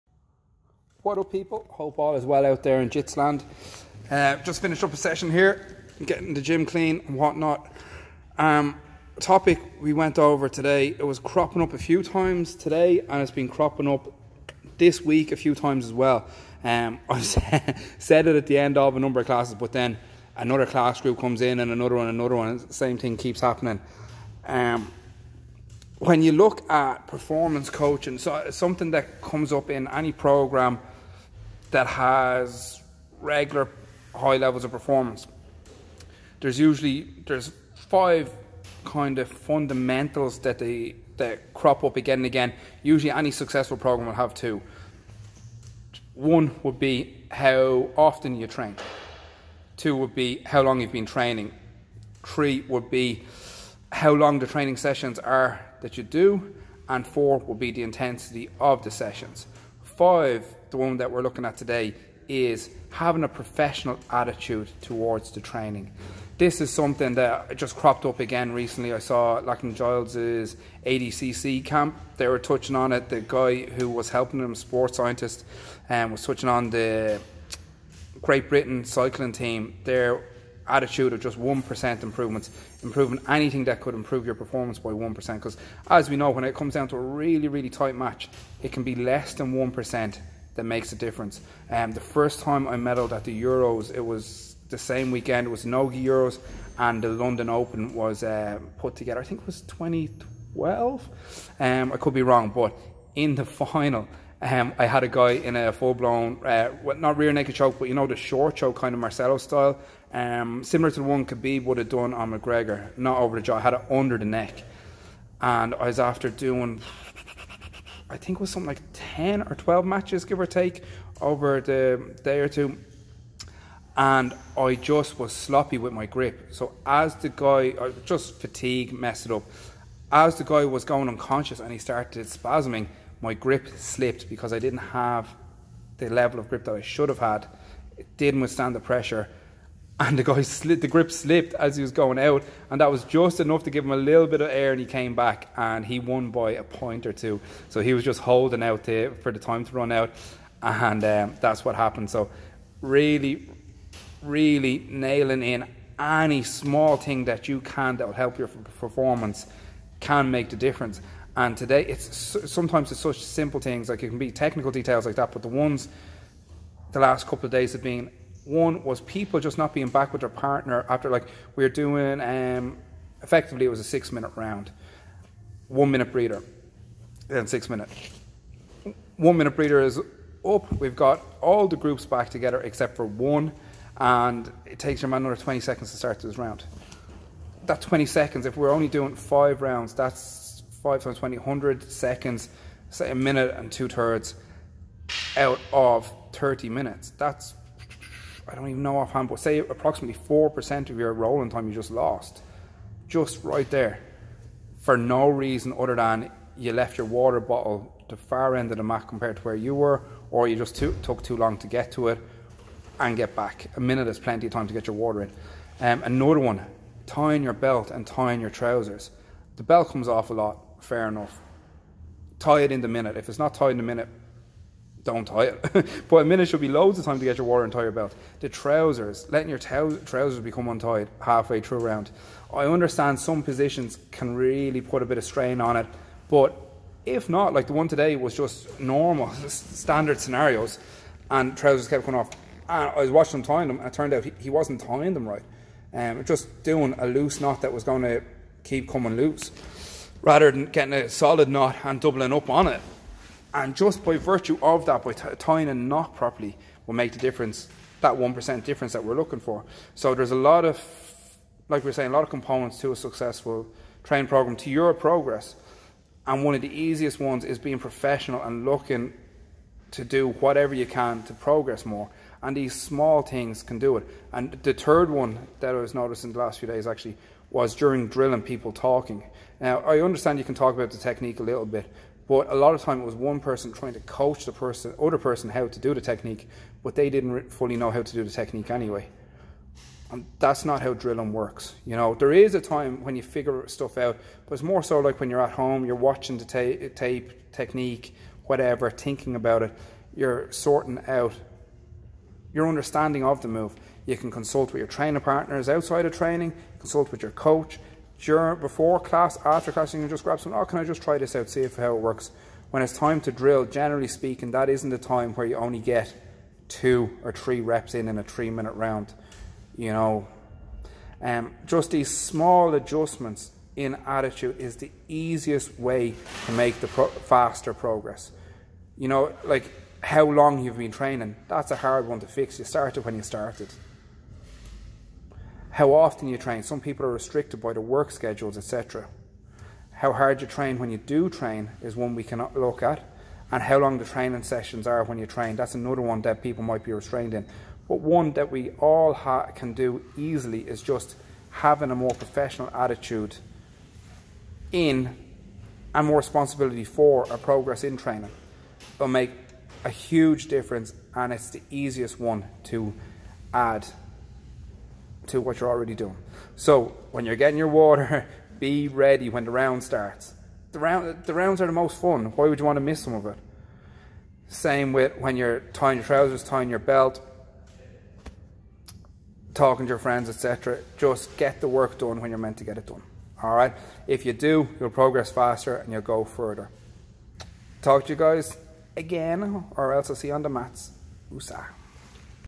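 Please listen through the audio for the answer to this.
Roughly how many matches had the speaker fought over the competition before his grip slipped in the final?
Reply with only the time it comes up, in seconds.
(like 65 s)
118 s.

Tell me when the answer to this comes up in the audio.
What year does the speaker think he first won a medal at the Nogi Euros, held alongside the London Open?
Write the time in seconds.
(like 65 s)
99 s.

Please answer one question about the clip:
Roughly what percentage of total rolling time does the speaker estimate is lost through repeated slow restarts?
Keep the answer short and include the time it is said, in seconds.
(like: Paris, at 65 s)
4%, at 200 s.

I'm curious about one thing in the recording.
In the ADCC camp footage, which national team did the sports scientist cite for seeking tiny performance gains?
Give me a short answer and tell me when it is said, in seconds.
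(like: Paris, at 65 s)
Great Britain cycling team, at 78 s.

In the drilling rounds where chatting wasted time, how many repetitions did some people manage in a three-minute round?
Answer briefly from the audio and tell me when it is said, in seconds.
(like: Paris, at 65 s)
two or three, at 316 s.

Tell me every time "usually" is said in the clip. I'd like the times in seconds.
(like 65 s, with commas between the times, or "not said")
36 s, 42 s.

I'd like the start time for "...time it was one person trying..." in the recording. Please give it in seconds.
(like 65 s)
282 s.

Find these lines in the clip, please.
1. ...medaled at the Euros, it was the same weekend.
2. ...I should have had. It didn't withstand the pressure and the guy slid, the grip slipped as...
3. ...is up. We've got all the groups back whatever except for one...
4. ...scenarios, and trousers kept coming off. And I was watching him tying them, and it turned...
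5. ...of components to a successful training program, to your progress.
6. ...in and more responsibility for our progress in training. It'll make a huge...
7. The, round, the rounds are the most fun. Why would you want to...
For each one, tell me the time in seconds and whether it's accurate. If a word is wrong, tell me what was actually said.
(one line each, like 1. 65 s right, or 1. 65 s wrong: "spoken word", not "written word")
1. 92 s right
2. 136 s right
3. 179 s wrong: "together", not "whatever"
4. 240 s right
5. 262 s right
6. 354 s right
7. 370 s right.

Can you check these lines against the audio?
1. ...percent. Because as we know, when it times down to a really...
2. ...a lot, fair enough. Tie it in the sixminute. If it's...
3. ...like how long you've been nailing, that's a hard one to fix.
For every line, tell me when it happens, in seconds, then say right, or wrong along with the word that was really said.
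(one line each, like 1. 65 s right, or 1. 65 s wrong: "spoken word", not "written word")
1. 85 s wrong: "comes", not "times"
2. 220 s wrong: "minute", not "sixminute"
3. 329 s wrong: "training", not "nailing".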